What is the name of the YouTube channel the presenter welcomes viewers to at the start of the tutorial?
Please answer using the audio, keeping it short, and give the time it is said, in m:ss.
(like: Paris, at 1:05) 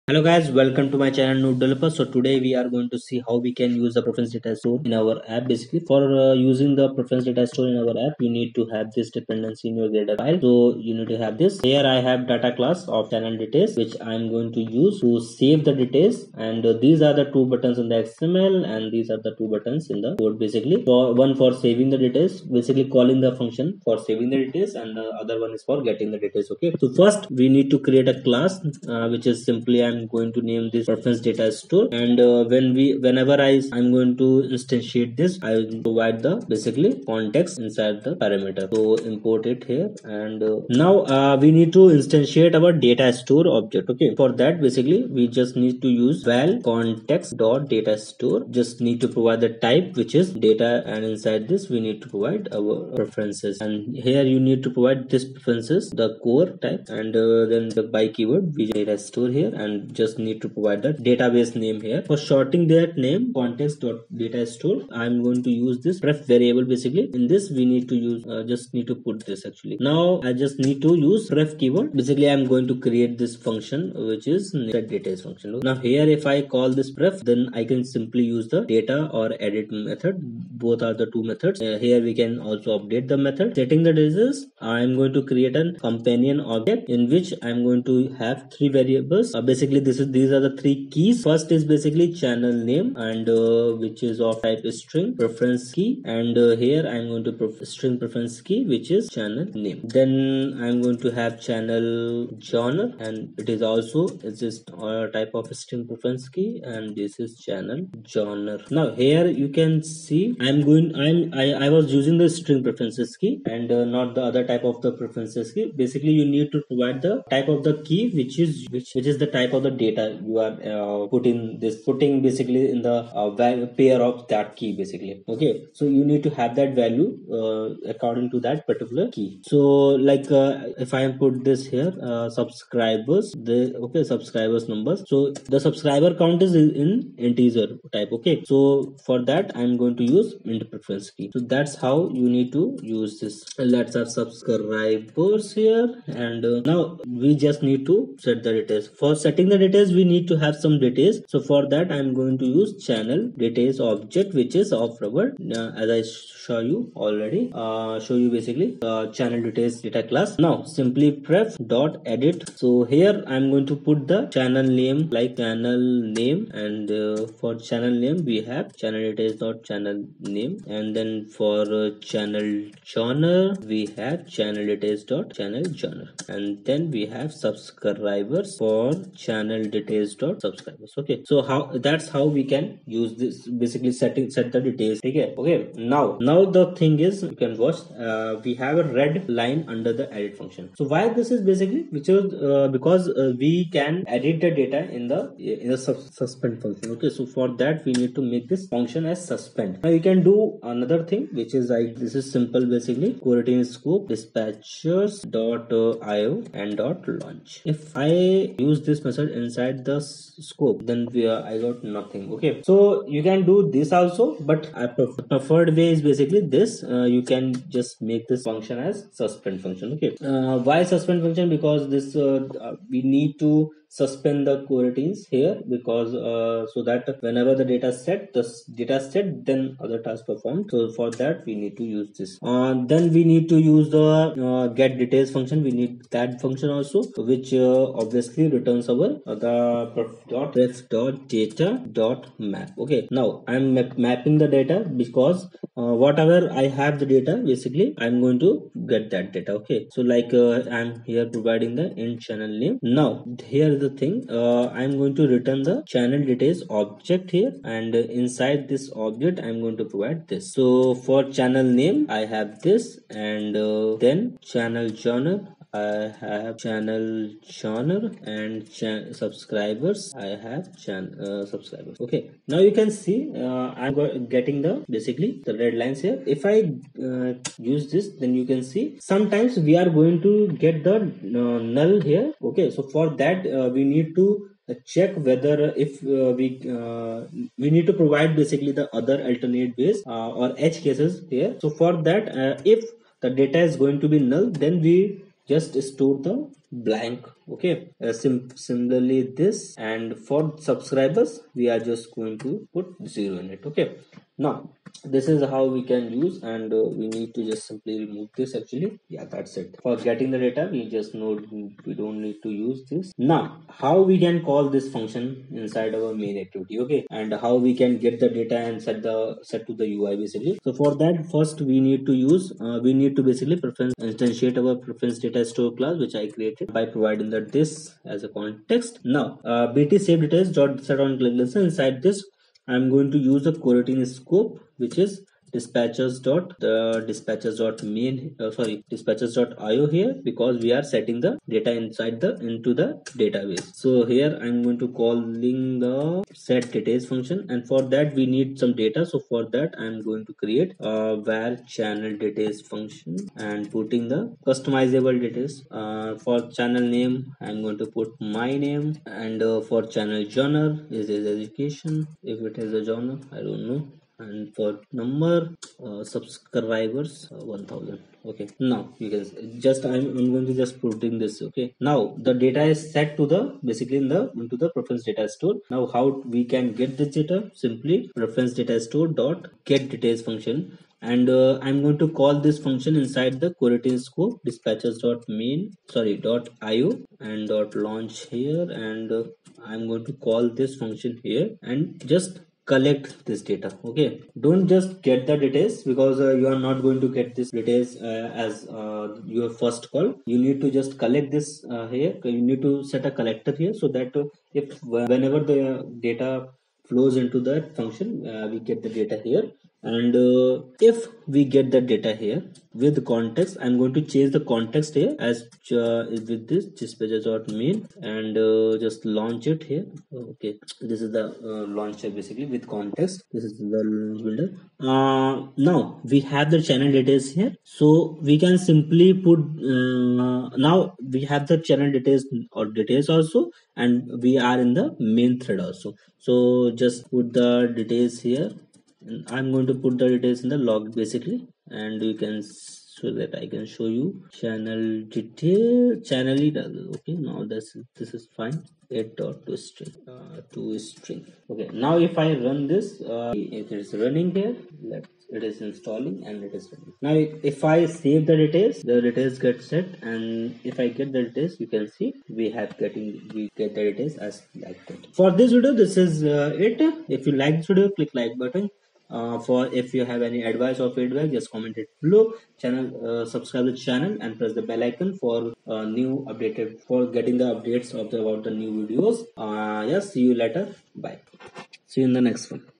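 Node Developer, at 0:01.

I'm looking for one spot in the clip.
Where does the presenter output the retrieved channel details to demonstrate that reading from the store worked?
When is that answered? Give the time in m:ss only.
7:20.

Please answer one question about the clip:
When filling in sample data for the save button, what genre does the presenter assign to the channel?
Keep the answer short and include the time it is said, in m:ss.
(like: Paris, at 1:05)
education, at 6:01.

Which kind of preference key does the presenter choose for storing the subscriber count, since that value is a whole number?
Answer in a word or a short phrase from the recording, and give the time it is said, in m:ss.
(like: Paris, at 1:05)
int preference key, at 2:20.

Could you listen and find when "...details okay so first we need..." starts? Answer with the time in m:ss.
0:26.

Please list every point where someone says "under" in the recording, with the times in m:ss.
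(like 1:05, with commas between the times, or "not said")
3:09.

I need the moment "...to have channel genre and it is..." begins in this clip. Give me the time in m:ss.
1:41.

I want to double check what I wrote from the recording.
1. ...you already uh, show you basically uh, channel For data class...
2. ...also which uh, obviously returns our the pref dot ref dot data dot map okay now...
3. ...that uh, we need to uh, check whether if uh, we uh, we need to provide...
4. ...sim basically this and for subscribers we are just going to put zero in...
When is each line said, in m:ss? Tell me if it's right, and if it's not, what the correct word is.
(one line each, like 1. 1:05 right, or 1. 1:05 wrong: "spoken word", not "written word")
1. 2:36 wrong: "Details", not "For"
2. 3:56 right
3. 4:43 right
4. 4:58 wrong: "similarly", not "basically".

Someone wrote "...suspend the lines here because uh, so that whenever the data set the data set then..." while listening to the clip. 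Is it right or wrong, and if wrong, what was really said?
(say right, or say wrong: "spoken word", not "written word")
wrong: "coroutines", not "lines".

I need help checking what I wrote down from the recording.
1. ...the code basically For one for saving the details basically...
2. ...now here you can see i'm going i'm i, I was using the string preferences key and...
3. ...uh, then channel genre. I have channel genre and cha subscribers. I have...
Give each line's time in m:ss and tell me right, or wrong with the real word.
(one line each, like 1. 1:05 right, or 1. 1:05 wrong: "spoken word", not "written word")
1. 0:20 right
2. 1:48 right
3. 4:23 right.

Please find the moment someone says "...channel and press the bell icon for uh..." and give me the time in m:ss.
7:53.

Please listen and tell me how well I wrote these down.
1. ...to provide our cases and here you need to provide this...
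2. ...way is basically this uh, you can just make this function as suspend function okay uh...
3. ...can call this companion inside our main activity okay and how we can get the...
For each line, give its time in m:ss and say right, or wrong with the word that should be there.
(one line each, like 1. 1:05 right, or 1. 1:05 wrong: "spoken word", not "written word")
1. 0:52 wrong: "preferences", not "cases"
2. 3:35 right
3. 5:14 wrong: "function", not "companion".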